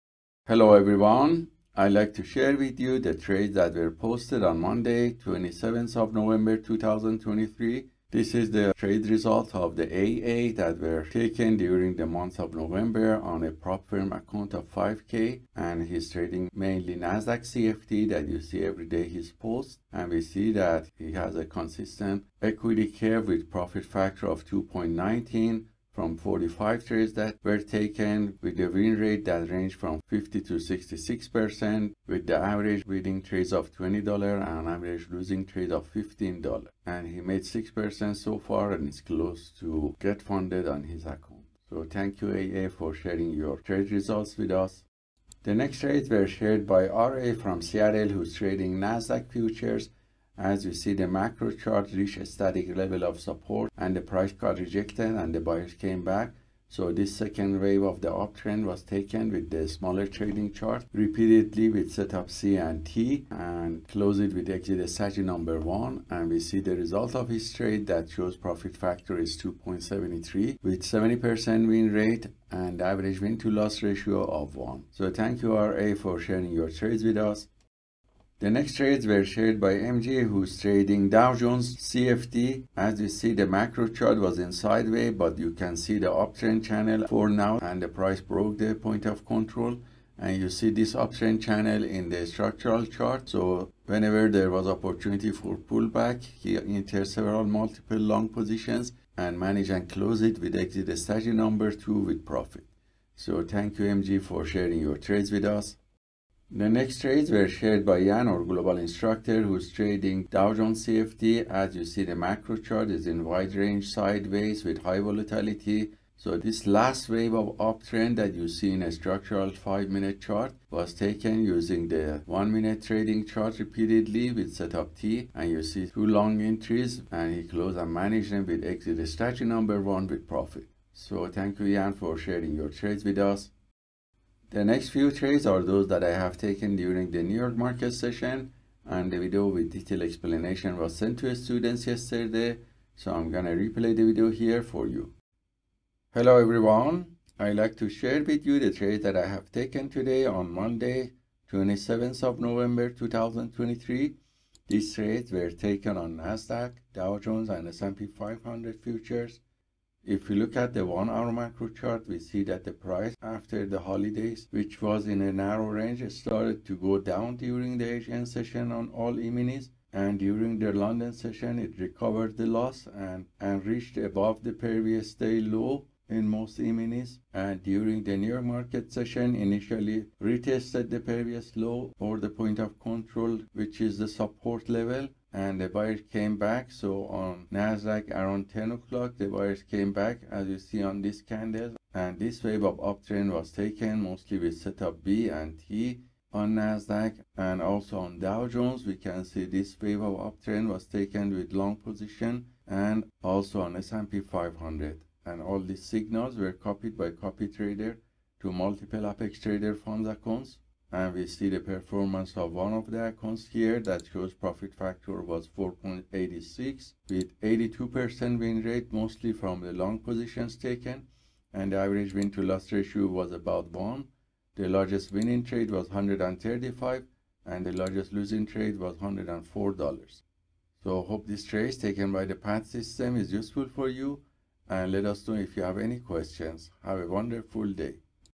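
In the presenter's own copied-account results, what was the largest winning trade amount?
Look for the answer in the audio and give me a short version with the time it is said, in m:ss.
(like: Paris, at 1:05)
135, at 3:45.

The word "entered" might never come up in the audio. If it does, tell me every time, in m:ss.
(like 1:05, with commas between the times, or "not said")
1:36.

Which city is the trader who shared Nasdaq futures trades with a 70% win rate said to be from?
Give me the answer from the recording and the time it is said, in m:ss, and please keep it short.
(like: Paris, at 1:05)
Seattle, at 0:47.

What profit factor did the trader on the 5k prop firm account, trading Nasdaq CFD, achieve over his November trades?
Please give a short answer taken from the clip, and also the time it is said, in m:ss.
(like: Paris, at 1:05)
2.19, at 0:24.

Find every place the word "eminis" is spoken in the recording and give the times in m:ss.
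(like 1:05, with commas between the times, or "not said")
2:49, 2:56.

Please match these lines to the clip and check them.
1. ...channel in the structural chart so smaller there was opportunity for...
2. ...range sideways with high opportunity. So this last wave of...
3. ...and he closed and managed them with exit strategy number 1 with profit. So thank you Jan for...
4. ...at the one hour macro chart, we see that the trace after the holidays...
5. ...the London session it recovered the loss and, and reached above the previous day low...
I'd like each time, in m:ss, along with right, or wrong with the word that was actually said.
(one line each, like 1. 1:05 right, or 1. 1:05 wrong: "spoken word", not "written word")
1. 1:31 wrong: "whenever", not "smaller"
2. 1:53 wrong: "volatility", not "opportunity"
3. 2:07 right
4. 2:40 wrong: "price", not "trace"
5. 2:50 right.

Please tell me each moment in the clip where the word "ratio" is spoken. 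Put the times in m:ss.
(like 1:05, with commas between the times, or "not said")
1:13, 3:42.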